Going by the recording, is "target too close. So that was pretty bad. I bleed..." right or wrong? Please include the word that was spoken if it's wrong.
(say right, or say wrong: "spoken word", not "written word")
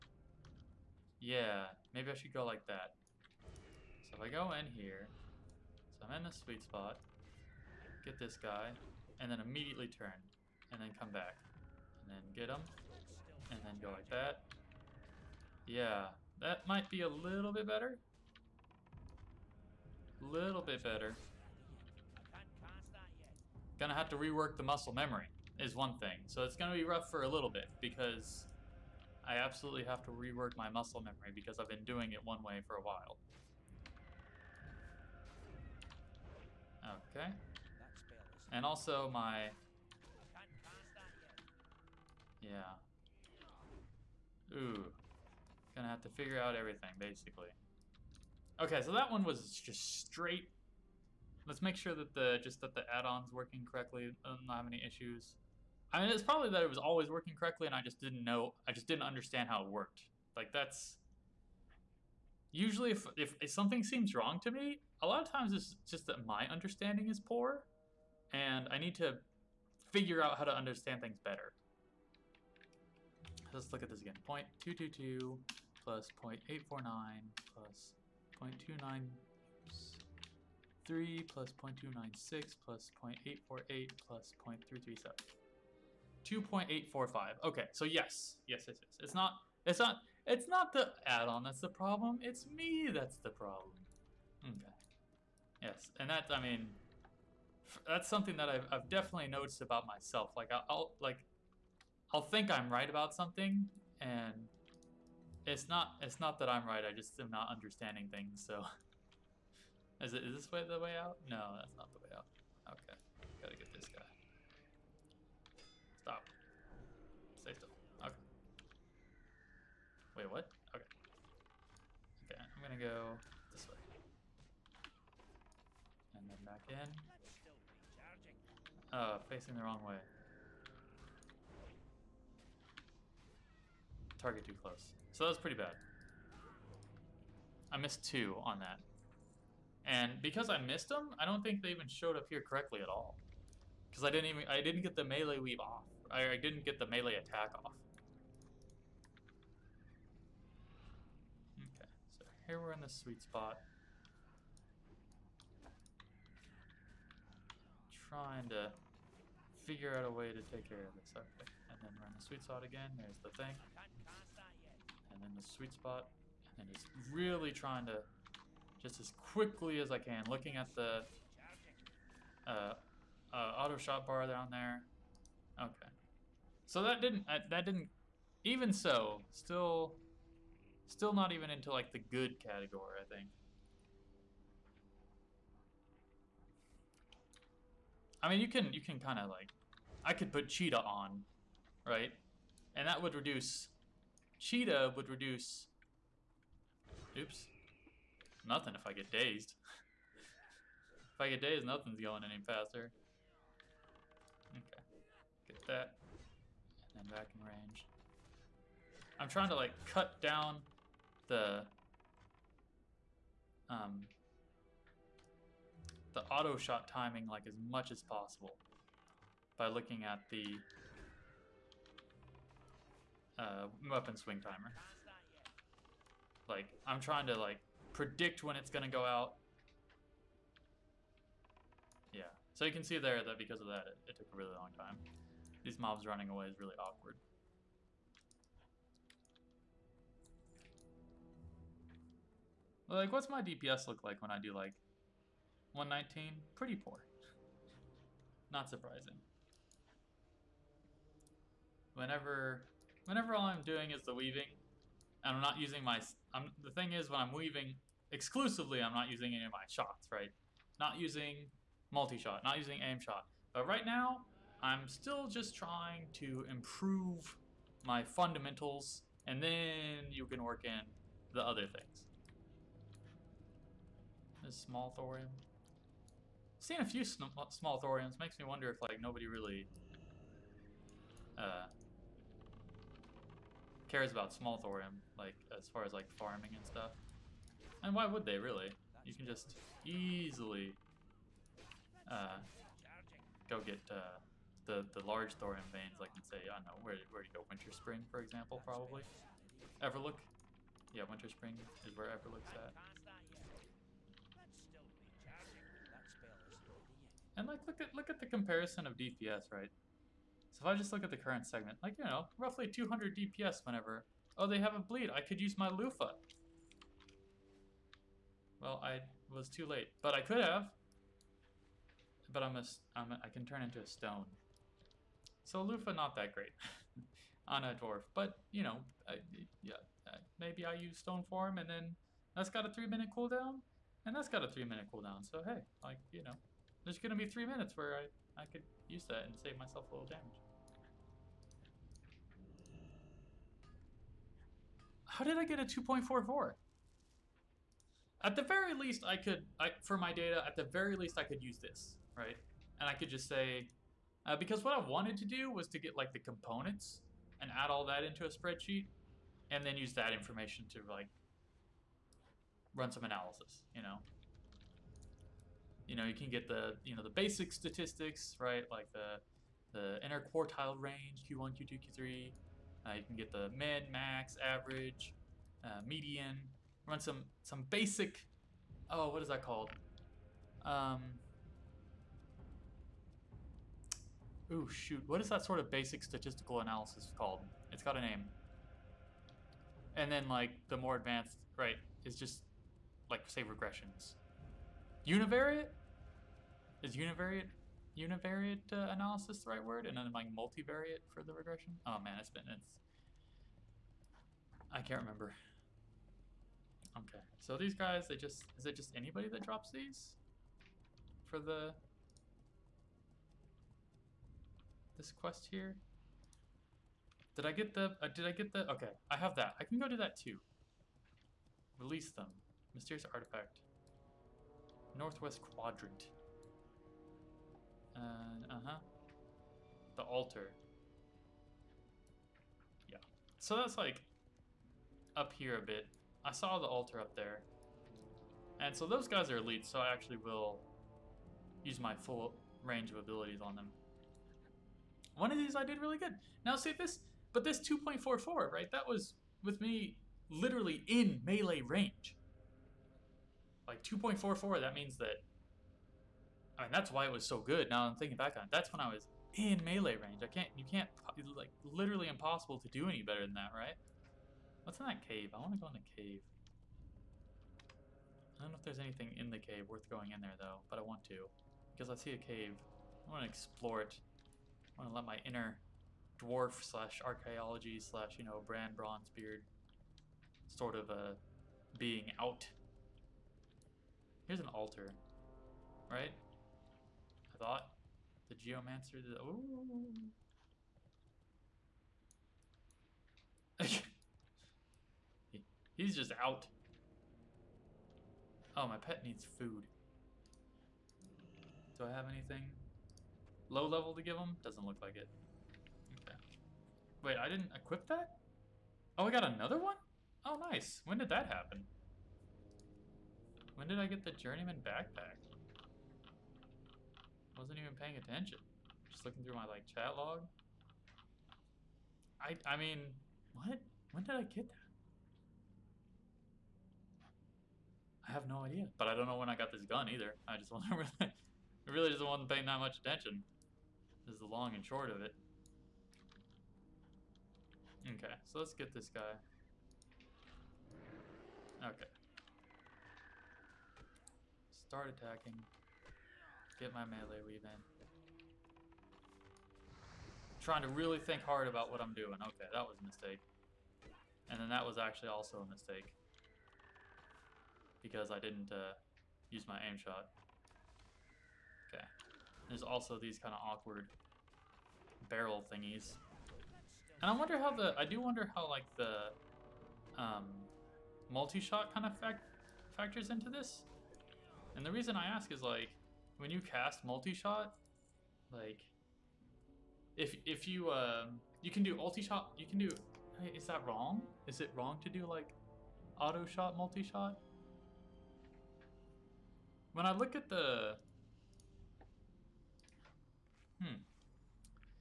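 wrong: "missed", not "bleed".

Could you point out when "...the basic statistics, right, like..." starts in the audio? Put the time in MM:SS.
06:07.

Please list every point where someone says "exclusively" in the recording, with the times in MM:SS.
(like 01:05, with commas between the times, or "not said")
04:18.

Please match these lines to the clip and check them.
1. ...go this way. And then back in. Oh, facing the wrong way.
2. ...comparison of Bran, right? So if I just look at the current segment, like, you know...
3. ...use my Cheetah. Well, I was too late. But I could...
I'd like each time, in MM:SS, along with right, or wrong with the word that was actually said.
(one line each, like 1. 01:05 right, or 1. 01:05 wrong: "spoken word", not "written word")
1. 02:02 right
2. 05:08 wrong: "DPS", not "Bran"
3. 05:15 wrong: "Lufa", not "Cheetah".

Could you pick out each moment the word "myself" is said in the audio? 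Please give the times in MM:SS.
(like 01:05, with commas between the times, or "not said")
01:39, 05:39.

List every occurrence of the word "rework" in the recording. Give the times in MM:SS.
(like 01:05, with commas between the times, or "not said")
00:24, 00:30.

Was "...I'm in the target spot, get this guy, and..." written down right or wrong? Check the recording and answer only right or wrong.
wrong.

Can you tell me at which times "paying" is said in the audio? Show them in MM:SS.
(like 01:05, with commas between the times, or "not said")
08:37, 08:52.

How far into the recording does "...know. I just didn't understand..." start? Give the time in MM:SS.
00:58.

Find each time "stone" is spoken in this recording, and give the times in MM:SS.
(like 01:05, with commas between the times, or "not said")
05:23, 05:30.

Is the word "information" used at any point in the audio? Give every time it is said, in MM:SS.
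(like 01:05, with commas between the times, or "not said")
06:00.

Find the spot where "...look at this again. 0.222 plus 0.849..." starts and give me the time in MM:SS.
01:13.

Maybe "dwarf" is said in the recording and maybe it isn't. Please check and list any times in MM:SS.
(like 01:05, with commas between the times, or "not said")
05:27, 07:56.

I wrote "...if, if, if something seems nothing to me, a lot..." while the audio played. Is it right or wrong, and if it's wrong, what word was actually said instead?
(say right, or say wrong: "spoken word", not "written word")
wrong: "wrong", not "nothing".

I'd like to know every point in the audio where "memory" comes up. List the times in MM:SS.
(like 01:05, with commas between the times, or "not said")
00:24, 00:31.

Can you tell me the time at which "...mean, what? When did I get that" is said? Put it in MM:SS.
08:42.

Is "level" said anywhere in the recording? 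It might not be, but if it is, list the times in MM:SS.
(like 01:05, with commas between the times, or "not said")
08:23.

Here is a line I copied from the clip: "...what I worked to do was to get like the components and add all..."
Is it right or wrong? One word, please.
wrong.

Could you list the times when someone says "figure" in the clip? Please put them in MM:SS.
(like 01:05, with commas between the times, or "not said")
00:46, 01:09, 02:39.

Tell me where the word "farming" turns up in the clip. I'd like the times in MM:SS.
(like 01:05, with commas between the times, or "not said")
04:46.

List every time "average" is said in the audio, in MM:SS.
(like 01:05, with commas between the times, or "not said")
06:14.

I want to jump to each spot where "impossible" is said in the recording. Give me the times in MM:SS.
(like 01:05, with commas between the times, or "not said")
07:42.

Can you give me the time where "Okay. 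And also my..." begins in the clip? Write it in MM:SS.
00:37.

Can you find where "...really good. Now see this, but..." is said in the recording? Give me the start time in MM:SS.
07:25.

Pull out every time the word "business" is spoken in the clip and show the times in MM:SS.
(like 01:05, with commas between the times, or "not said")
not said.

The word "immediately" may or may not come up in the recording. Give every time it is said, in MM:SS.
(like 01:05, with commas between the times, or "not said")
00:09.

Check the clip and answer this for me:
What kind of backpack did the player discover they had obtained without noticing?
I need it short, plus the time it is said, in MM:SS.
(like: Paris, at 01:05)
Journeyman backpack, at 08:34.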